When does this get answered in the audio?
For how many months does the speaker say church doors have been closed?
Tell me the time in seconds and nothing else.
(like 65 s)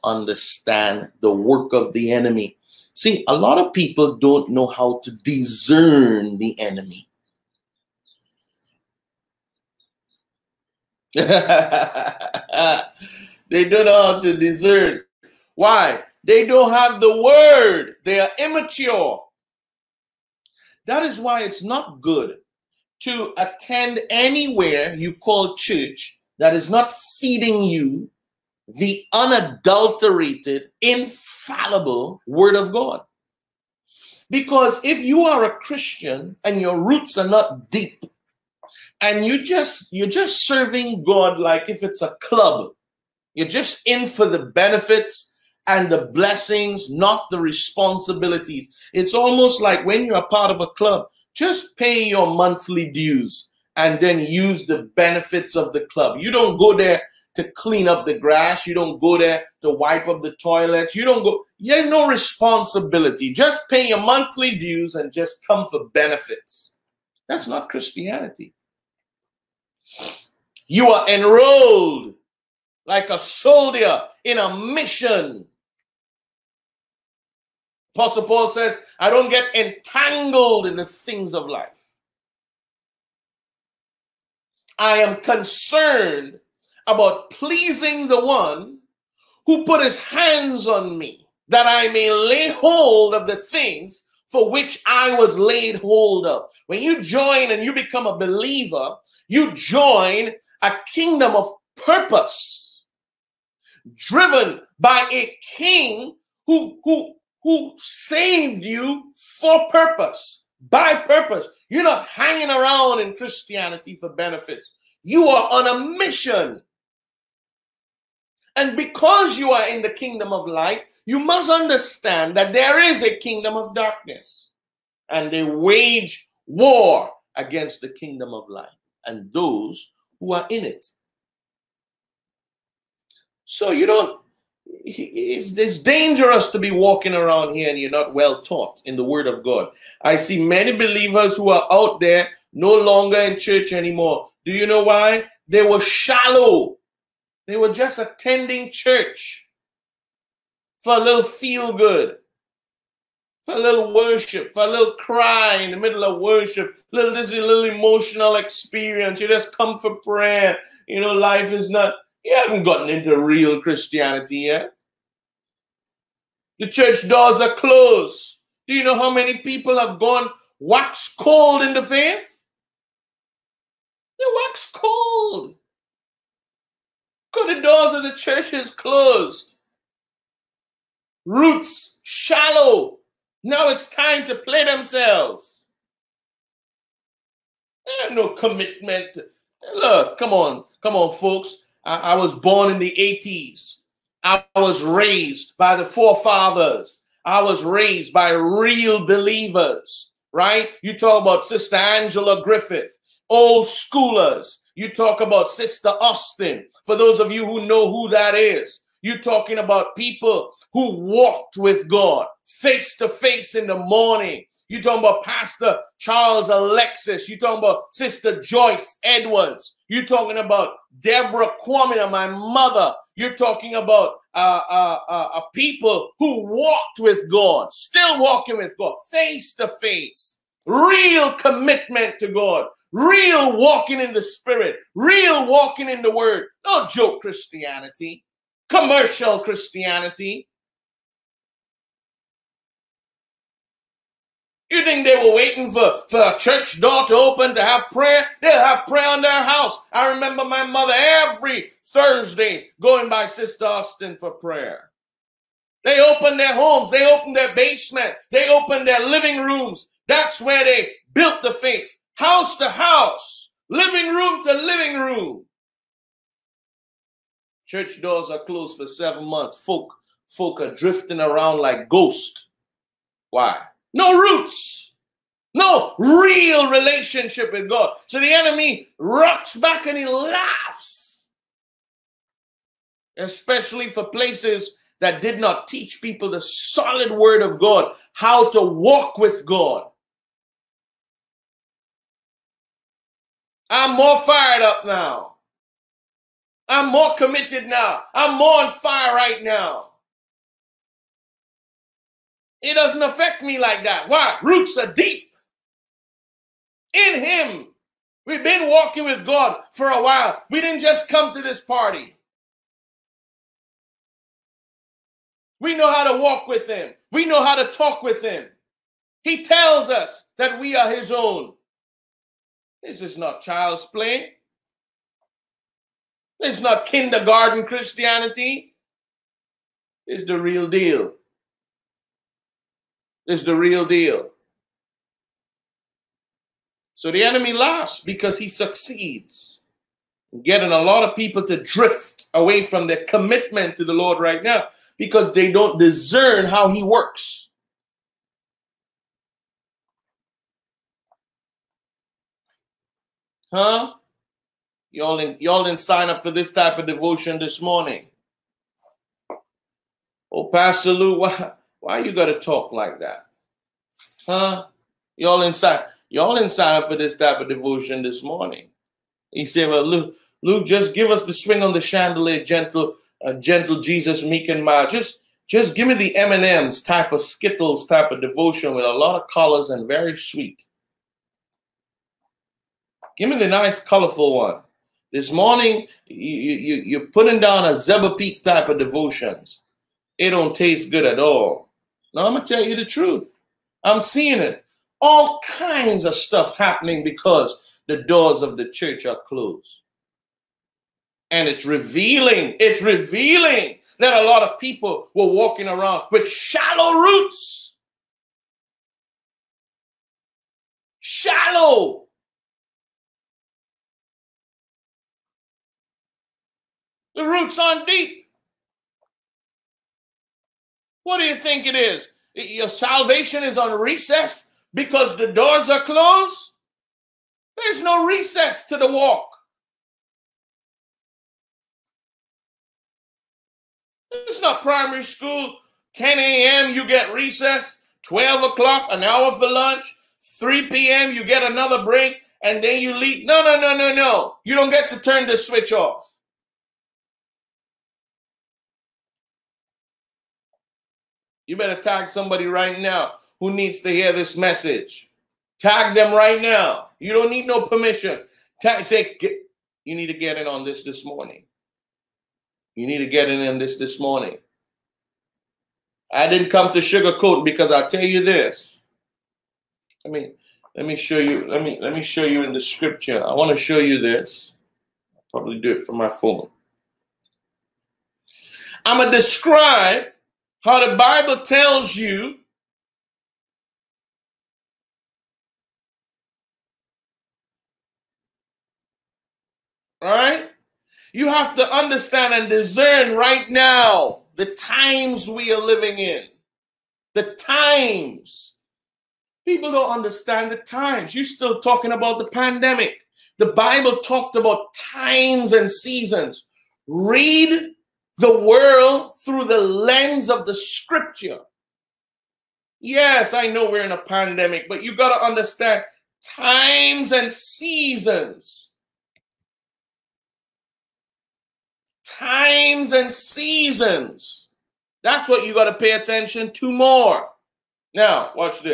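268 s.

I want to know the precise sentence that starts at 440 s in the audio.
3 p.m., you get another break, and then you leave.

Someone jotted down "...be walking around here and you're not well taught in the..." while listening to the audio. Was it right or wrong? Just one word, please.
right.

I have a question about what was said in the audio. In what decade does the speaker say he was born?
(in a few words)
1980s.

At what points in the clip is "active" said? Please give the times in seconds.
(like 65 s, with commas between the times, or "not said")
not said.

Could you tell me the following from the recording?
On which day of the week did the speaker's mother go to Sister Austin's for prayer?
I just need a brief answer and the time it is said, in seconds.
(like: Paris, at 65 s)
Thursday, at 251 s.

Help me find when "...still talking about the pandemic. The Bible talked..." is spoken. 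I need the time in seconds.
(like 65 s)
501 s.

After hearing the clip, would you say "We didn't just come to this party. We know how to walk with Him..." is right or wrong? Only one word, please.
right.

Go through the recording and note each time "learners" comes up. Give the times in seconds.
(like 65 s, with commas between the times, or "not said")
not said.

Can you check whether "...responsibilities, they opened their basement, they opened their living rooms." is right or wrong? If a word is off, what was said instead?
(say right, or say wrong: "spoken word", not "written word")
wrong: "homes", not "responsibilities".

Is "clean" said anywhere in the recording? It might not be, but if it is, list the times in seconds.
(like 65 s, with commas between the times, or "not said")
57 s.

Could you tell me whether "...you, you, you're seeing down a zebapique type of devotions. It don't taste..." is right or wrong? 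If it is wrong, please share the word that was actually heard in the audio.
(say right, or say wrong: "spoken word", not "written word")
wrong: "putting", not "seeing".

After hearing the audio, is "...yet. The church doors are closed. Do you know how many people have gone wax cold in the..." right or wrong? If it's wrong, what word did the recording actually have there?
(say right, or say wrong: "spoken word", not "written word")
right.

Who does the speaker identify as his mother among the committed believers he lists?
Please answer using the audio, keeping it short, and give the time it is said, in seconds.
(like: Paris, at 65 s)
Deborah Quamina, at 221 s.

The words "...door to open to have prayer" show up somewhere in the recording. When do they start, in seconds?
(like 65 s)
246 s.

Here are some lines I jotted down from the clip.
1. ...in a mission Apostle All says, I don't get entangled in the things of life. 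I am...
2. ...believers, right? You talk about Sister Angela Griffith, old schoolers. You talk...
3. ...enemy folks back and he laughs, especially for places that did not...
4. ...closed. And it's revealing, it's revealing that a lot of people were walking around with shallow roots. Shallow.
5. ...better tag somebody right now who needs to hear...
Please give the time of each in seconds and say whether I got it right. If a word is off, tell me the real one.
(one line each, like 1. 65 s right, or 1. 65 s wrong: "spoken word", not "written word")
1. 74 s wrong: "Paul", not "All"
2. 199 s right
3. 278 s wrong: "rocks", not "folks"
4. 399 s right
5. 451 s right.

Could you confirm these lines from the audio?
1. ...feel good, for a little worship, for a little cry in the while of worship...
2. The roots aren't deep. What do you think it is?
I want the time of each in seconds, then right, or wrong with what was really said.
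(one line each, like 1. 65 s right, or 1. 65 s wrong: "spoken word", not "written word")
1. 151 s wrong: "middle", not "while"
2. 417 s right.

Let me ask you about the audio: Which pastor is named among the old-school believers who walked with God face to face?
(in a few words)
Charles Alexis.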